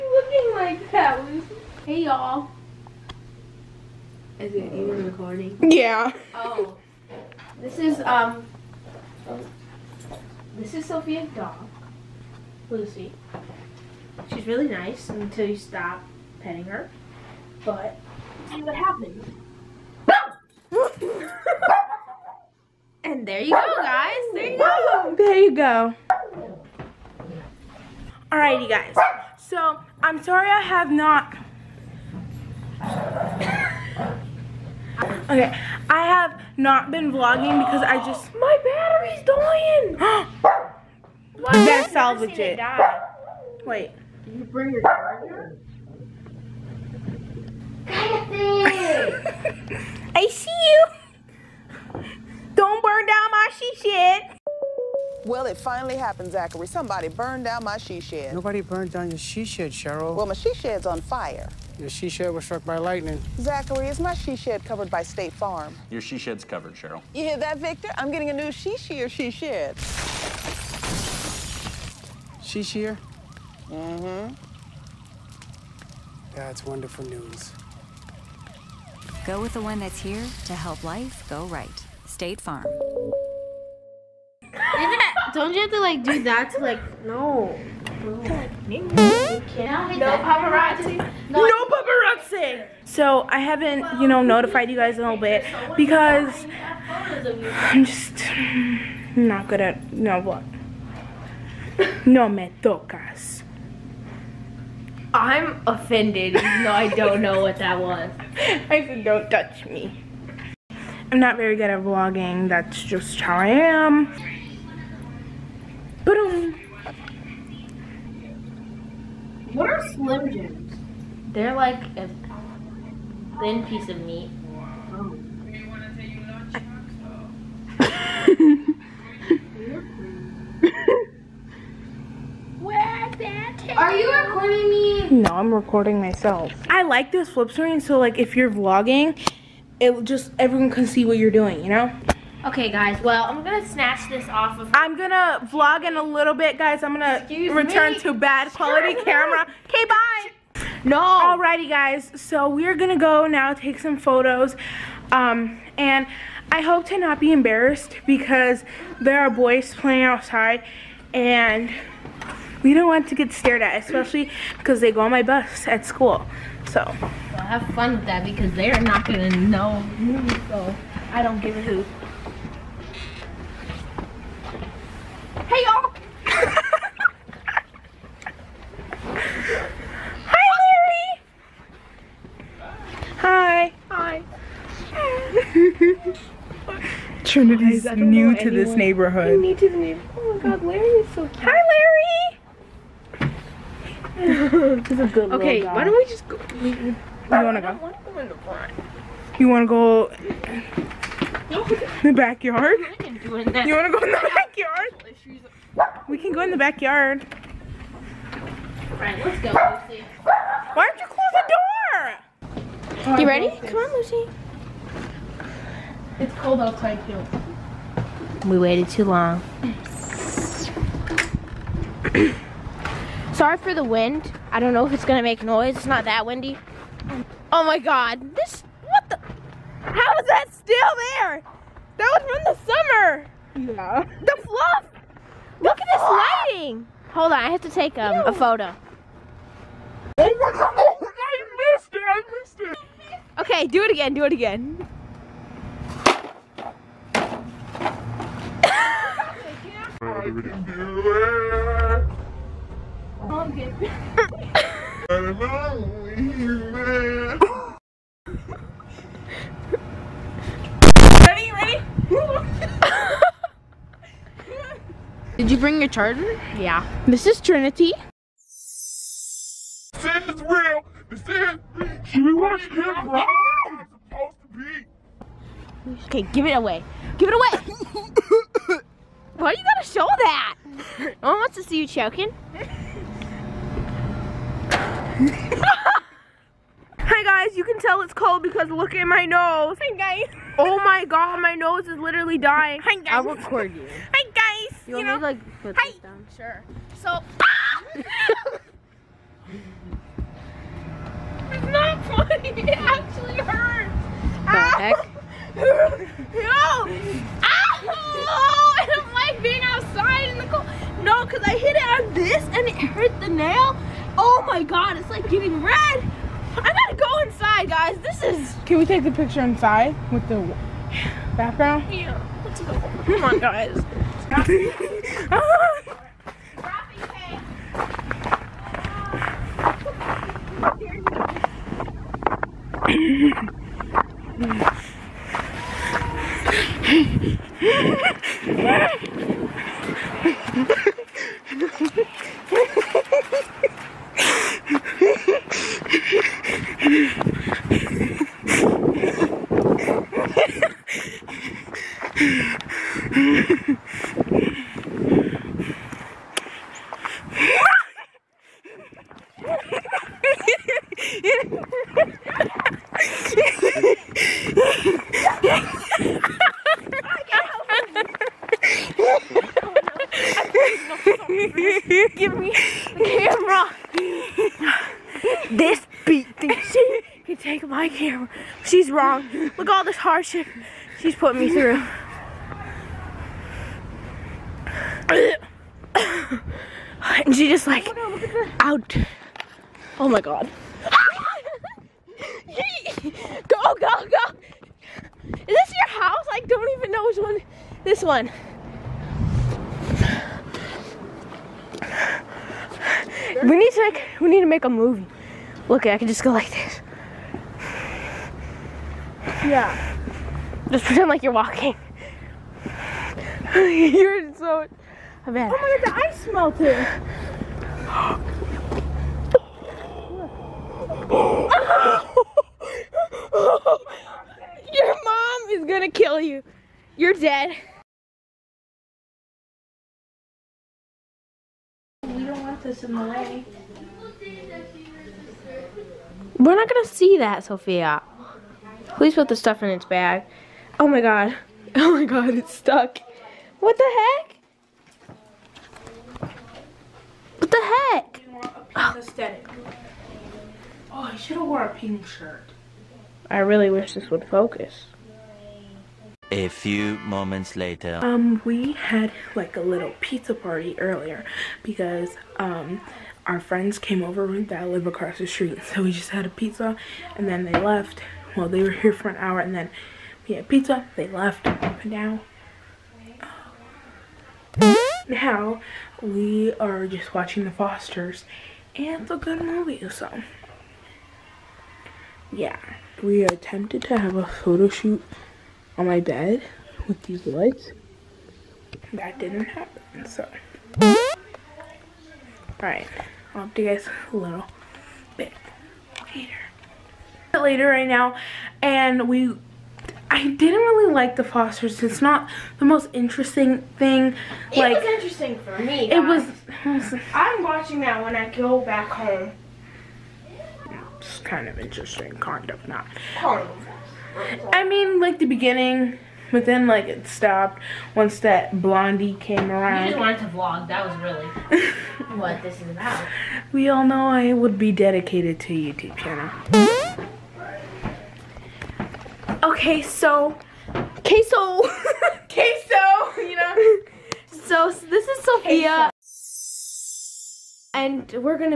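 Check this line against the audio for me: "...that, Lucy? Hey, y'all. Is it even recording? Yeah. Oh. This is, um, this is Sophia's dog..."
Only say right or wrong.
right.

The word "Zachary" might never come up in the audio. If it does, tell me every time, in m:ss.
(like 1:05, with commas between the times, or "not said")
0:56, 1:03.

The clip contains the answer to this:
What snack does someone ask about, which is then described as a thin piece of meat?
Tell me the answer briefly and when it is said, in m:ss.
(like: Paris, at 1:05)
Slim Jims, at 1:59.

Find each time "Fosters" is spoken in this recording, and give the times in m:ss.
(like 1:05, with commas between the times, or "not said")
7:57, 8:21.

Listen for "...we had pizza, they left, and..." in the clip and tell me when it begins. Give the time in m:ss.
7:50.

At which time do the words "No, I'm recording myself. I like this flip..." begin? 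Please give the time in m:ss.
2:15.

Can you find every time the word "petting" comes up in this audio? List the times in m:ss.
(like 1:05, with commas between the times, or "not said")
0:16.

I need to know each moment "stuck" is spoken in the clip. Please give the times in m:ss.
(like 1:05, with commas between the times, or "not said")
7:22.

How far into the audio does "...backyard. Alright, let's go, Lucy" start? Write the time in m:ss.
3:26.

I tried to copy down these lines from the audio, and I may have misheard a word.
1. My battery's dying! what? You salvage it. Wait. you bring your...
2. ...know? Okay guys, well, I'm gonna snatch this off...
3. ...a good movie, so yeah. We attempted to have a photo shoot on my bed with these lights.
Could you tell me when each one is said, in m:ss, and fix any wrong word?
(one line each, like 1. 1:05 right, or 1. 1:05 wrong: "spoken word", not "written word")
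1. 0:38 right
2. 2:21 right
3. 7:59 right.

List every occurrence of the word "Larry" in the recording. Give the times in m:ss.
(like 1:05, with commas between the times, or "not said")
3:00, 3:10.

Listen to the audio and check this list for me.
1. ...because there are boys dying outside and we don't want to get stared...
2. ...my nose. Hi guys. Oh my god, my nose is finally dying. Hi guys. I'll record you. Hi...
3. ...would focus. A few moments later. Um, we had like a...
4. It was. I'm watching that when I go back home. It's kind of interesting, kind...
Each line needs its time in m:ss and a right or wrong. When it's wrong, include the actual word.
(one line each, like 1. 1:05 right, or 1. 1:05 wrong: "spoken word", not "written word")
1. 2:38 wrong: "playing", not "dying"
2. 4:49 wrong: "literally", not "finally"
3. 7:34 right
4. 8:25 right.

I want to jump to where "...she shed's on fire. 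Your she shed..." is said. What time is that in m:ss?
1:00.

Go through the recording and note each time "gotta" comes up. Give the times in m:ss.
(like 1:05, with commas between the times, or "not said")
4:39, 5:16.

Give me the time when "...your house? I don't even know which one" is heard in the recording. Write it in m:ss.
6:35.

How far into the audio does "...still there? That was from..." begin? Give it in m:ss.
3:50.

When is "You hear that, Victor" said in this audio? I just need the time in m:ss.
1:07.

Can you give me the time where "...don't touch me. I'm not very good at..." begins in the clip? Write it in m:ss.
1:49.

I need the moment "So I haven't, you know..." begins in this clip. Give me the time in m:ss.
1:32.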